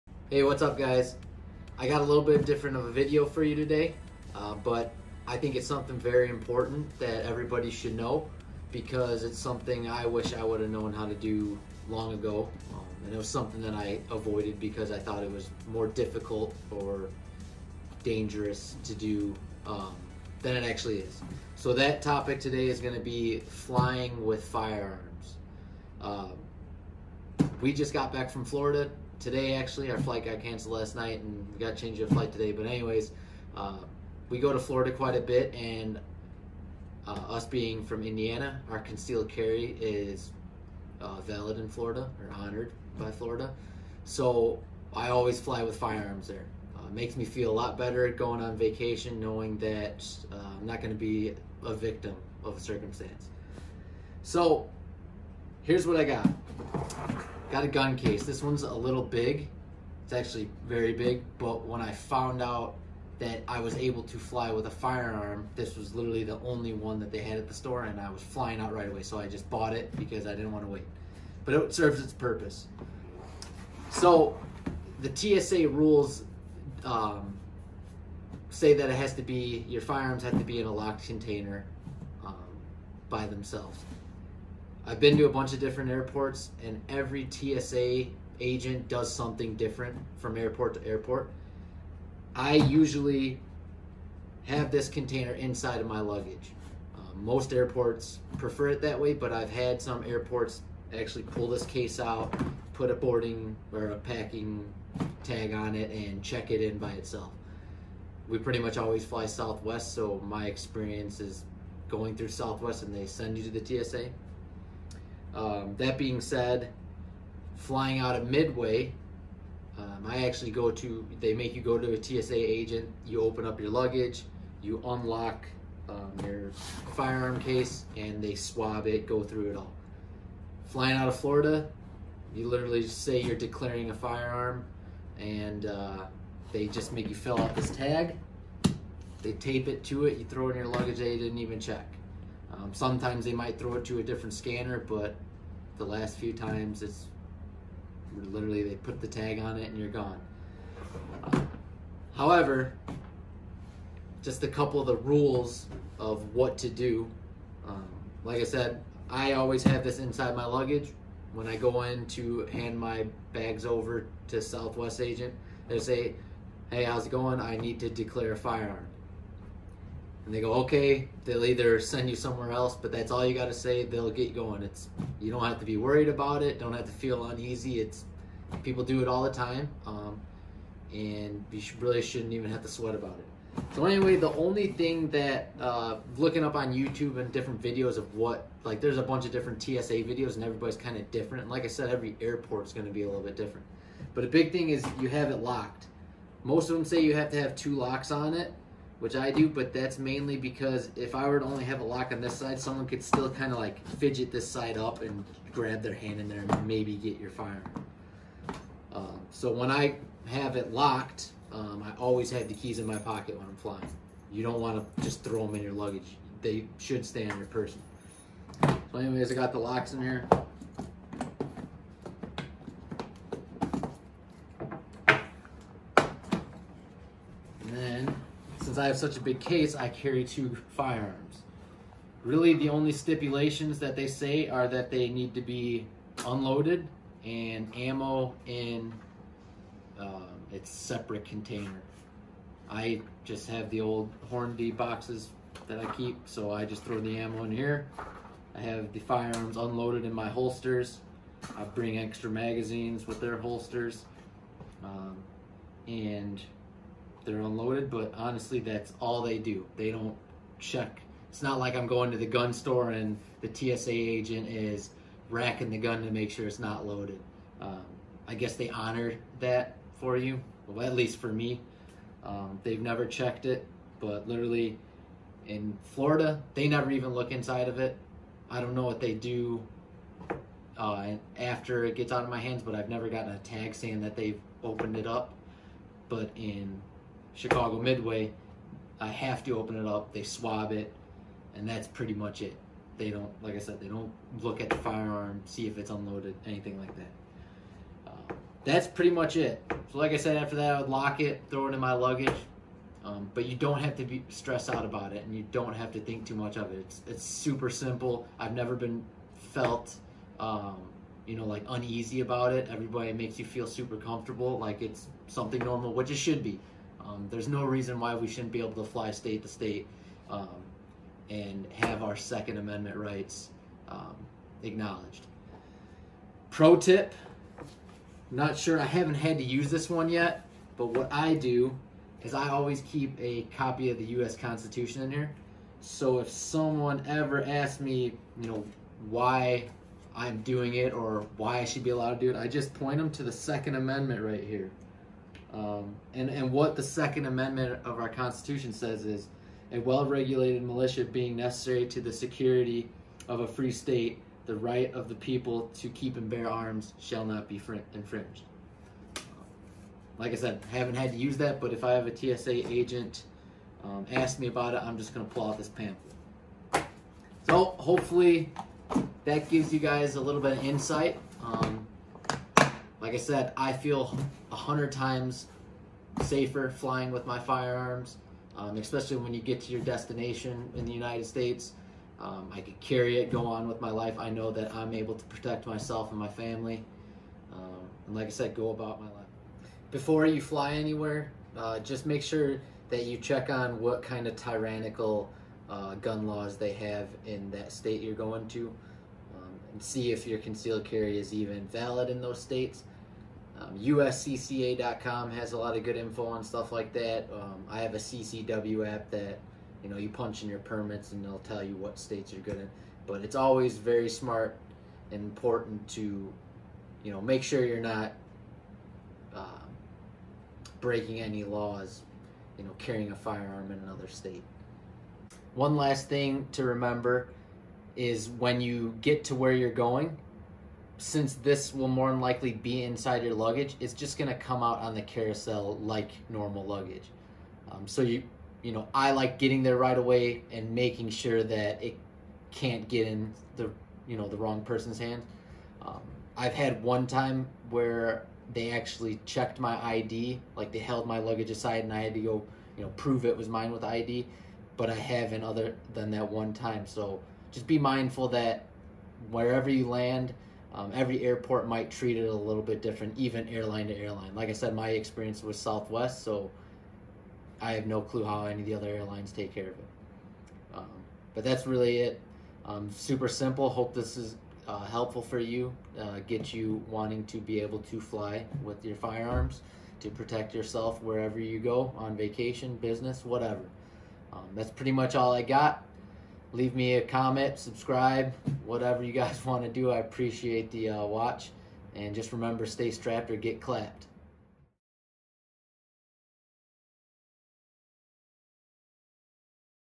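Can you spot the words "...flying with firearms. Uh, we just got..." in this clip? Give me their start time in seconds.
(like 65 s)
23 s.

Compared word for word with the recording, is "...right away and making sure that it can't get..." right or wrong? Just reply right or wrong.
right.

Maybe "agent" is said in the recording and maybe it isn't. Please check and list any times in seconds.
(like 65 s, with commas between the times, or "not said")
88 s, 122 s, 164 s, 263 s, 362 s.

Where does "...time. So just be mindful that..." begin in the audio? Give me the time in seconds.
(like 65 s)
456 s.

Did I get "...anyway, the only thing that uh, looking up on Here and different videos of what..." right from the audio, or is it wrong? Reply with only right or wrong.
wrong.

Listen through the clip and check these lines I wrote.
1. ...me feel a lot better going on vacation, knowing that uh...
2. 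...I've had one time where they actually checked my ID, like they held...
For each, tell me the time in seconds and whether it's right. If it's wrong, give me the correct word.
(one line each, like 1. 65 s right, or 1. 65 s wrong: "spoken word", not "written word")
1. 47 s right
2. 446 s right.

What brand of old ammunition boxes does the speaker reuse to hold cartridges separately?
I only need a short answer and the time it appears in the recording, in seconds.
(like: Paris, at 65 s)
Hornady, at 244 s.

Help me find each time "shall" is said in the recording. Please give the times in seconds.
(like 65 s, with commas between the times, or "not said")
356 s.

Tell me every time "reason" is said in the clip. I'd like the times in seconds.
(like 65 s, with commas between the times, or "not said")
317 s.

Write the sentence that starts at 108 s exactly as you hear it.
We pretty much always fly Southwest, so my experience is going through Southwest and they send you to the TSA.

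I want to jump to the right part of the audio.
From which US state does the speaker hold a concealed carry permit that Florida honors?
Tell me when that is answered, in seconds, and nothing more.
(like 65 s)
38 s.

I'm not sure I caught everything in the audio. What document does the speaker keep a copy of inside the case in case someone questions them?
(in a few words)
U.S. Constitution.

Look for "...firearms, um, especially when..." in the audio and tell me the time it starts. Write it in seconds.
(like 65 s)
377 s.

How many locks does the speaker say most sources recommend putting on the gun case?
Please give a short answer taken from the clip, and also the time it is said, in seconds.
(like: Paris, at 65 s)
2, at 197 s.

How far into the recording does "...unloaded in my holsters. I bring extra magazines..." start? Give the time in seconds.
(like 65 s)
249 s.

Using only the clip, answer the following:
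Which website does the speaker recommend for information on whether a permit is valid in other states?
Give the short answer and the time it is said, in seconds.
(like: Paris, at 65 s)
USCCA.com, at 403 s.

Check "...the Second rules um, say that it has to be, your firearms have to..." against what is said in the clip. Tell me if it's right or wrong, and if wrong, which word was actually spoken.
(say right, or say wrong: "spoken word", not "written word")
wrong: "TSA", not "Second".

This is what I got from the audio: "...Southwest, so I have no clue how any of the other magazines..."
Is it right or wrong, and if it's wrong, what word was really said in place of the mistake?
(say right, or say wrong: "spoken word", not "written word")
wrong: "airlines", not "magazines".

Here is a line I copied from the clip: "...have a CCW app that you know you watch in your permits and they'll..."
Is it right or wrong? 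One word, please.
wrong.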